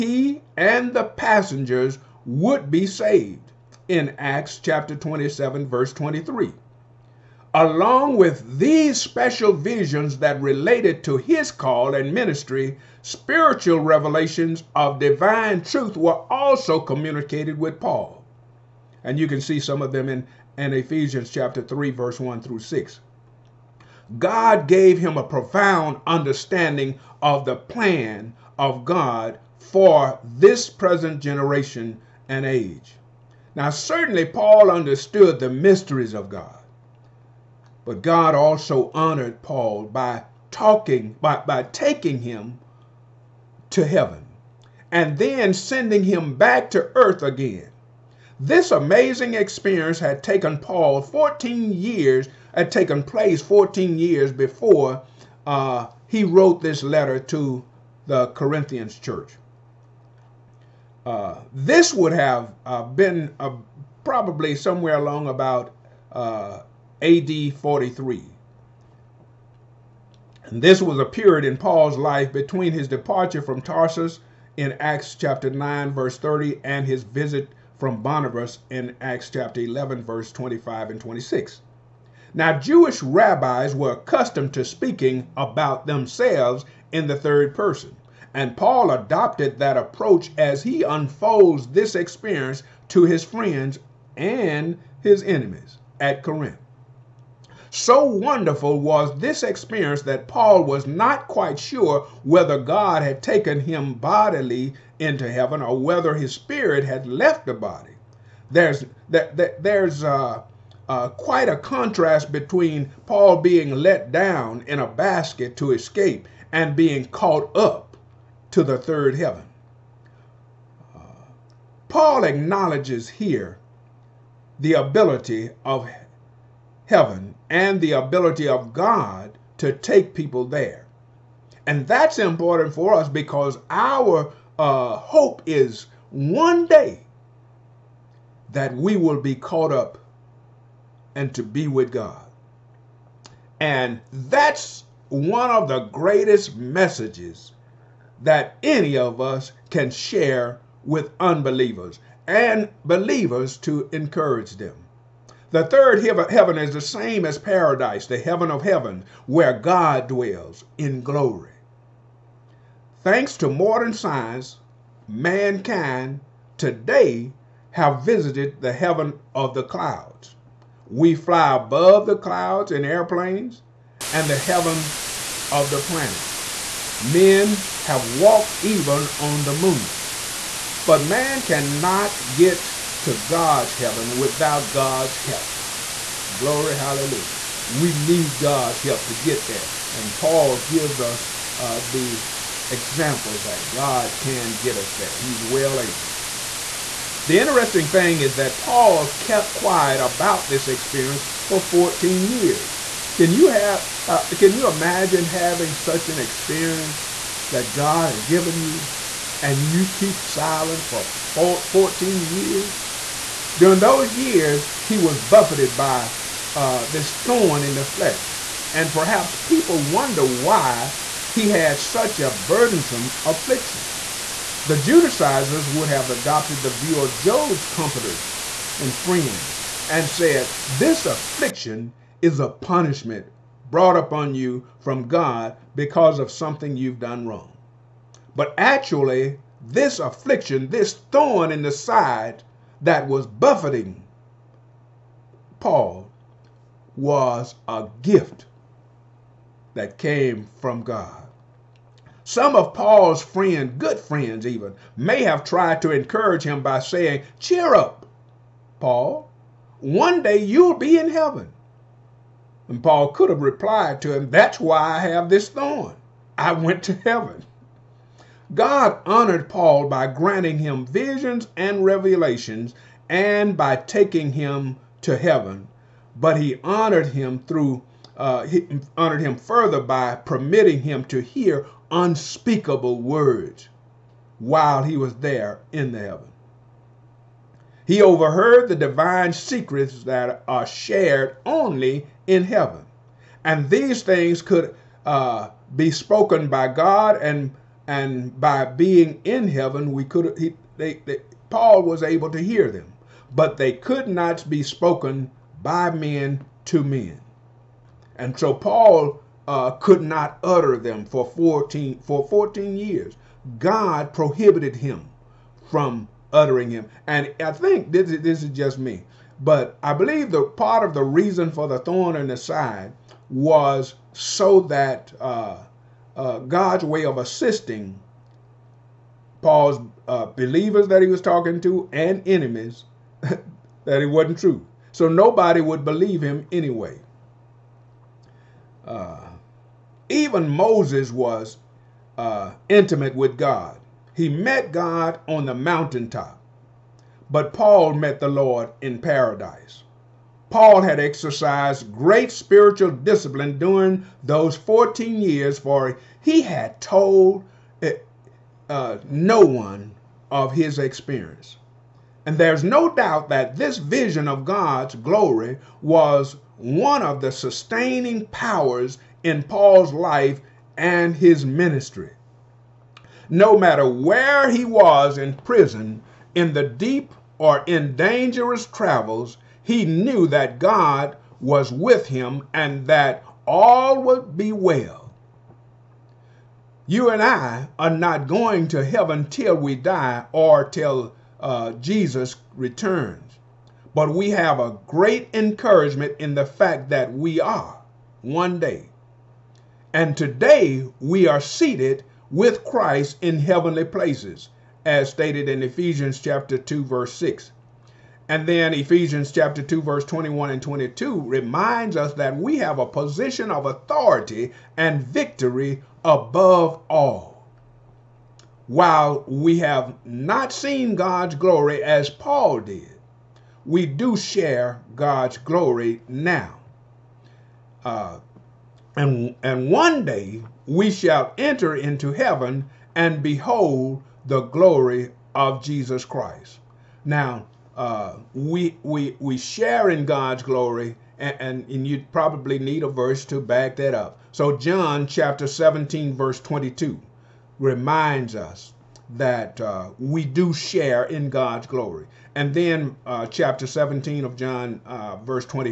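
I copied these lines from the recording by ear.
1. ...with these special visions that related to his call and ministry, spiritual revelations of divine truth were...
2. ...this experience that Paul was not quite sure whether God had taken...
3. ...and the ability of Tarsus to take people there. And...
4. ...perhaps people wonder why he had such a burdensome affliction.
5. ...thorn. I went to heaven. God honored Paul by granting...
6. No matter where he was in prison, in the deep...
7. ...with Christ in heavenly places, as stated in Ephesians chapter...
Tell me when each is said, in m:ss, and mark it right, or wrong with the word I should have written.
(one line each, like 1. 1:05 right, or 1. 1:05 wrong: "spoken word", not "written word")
1. 0:08 right
2. 1:39 right
3. 2:07 wrong: "God", not "Tarsus"
4. 3:38 right
5. 4:25 right
6. 6:13 right
7. 6:42 right.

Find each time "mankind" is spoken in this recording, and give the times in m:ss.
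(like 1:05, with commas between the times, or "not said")
2:45.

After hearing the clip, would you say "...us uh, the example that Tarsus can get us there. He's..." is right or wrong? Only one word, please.
wrong.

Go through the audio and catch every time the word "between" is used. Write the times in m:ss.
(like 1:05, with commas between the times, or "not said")
1:12, 1:52.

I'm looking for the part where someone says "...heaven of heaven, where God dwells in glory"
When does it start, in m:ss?
2:38.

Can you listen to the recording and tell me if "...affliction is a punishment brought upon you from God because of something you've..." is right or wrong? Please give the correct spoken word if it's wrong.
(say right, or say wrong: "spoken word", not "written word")
right.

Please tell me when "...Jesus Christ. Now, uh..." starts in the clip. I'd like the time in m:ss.
7:15.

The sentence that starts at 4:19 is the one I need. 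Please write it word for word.
One day you'll be in heaven.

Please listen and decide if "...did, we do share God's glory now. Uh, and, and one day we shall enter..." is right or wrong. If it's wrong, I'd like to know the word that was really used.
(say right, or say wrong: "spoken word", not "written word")
right.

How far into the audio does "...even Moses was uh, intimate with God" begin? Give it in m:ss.
5:40.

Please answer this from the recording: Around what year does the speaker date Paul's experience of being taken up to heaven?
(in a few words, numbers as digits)
AD 43.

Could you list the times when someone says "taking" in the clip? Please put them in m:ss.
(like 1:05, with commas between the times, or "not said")
0:41, 4:33.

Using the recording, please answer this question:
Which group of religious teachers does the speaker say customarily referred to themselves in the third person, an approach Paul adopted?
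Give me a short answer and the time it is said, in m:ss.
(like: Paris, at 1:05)
Jewish rabbis, at 1:22.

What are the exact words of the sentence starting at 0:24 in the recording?
God gave him a profound understanding of the plan of God for this present generation and age.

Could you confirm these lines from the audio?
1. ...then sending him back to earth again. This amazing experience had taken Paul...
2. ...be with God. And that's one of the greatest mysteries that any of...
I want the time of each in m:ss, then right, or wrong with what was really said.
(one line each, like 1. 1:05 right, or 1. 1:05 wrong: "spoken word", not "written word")
1. 0:45 right
2. 2:21 wrong: "messages", not "mysteries".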